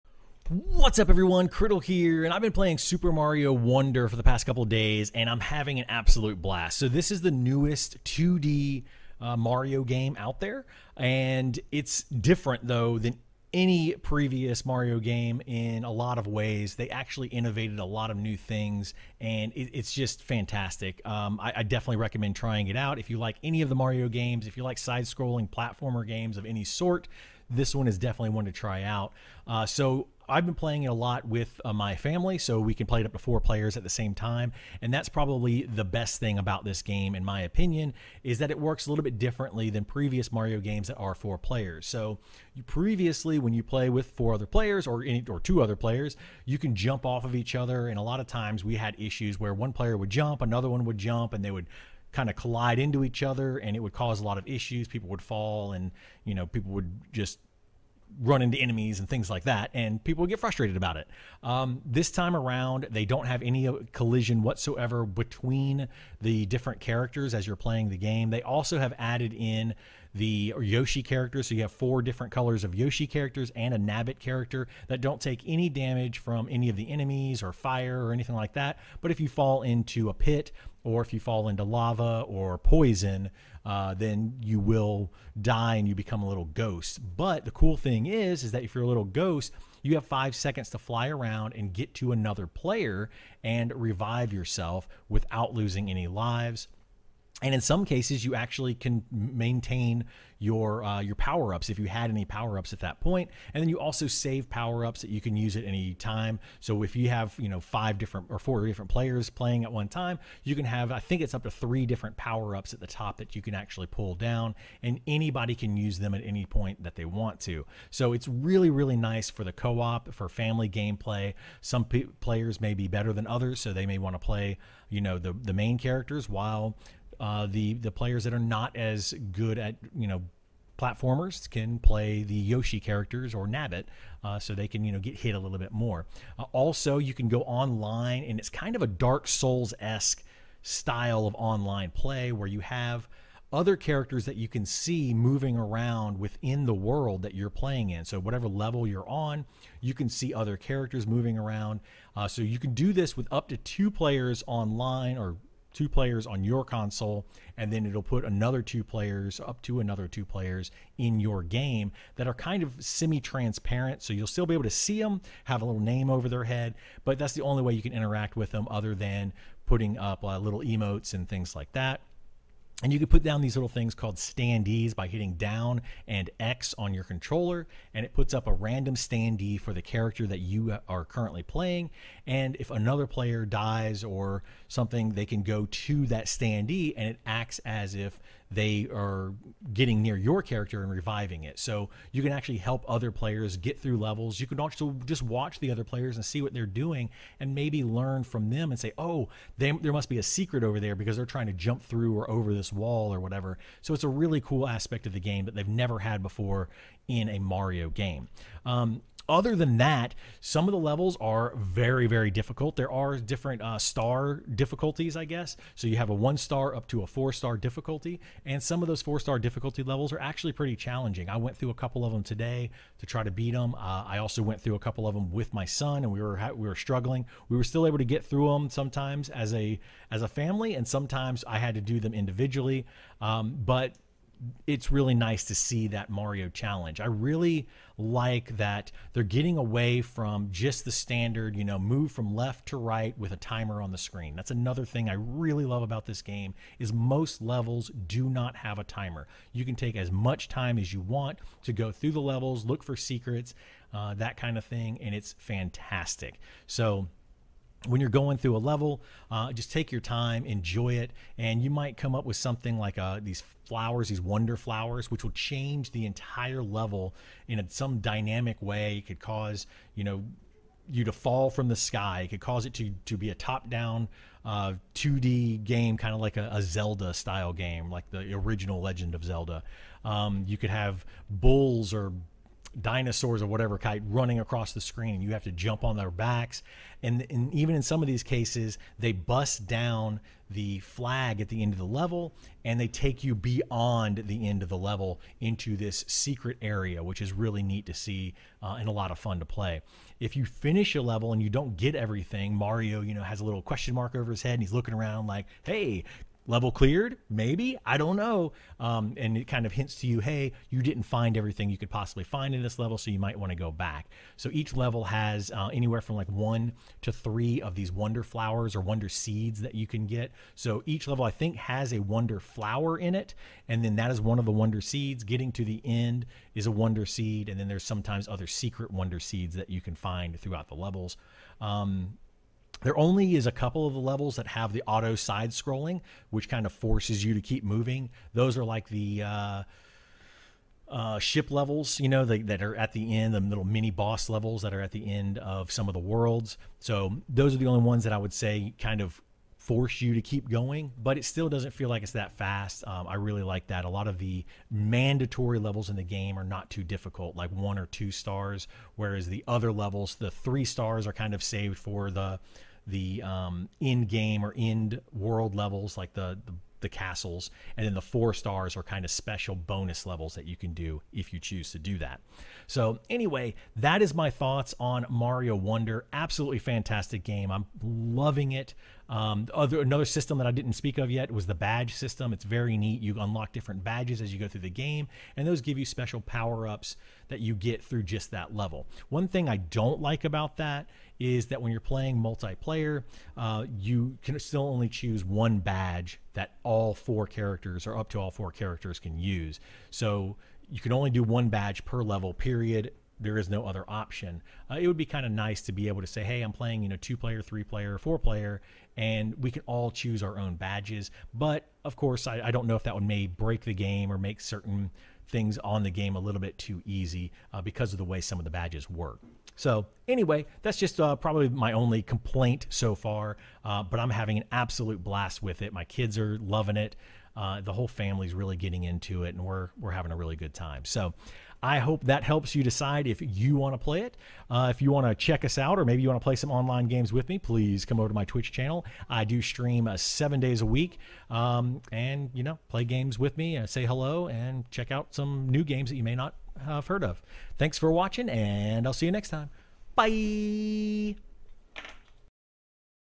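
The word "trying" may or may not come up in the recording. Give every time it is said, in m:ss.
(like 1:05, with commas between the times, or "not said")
0:22, 3:21.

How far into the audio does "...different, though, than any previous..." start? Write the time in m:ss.
0:12.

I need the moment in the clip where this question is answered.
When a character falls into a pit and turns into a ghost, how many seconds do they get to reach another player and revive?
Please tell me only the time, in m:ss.
1:30.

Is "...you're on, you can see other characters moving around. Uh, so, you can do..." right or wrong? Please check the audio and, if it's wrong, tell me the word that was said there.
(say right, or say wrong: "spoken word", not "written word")
right.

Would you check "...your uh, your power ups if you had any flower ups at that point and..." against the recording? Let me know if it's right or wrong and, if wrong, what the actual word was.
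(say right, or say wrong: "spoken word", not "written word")
wrong: "power", not "flower".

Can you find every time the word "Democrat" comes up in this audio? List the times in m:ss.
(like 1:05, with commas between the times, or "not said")
not said.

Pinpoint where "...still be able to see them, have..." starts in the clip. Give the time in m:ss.
2:44.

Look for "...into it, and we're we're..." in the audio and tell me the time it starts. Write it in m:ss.
7:08.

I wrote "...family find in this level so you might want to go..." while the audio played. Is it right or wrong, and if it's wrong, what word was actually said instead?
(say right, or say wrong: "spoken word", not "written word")
wrong: "possibly", not "family".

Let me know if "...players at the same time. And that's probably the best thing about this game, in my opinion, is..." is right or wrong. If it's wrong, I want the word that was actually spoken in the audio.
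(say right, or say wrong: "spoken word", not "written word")
right.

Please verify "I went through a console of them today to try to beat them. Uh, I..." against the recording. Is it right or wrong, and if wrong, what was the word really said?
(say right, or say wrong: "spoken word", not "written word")
wrong: "couple", not "console".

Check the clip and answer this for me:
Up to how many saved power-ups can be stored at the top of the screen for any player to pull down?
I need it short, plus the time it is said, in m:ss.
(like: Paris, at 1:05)
3, at 1:51.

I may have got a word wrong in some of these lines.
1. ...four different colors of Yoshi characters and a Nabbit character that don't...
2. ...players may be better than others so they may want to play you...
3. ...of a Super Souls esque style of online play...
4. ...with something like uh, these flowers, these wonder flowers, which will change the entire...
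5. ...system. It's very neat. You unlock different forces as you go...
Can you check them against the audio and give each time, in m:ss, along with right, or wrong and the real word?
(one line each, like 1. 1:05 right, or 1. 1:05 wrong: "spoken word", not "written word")
1. 1:11 right
2. 2:02 right
3. 2:18 wrong: "Dark", not "Super"
4. 4:22 right
5. 6:21 wrong: "badges", not "forces".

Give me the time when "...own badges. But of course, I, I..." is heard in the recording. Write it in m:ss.
6:50.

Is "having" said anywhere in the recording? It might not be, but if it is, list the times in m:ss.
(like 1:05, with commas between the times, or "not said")
0:05, 7:04, 7:09.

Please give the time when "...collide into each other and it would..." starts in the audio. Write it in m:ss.
0:52.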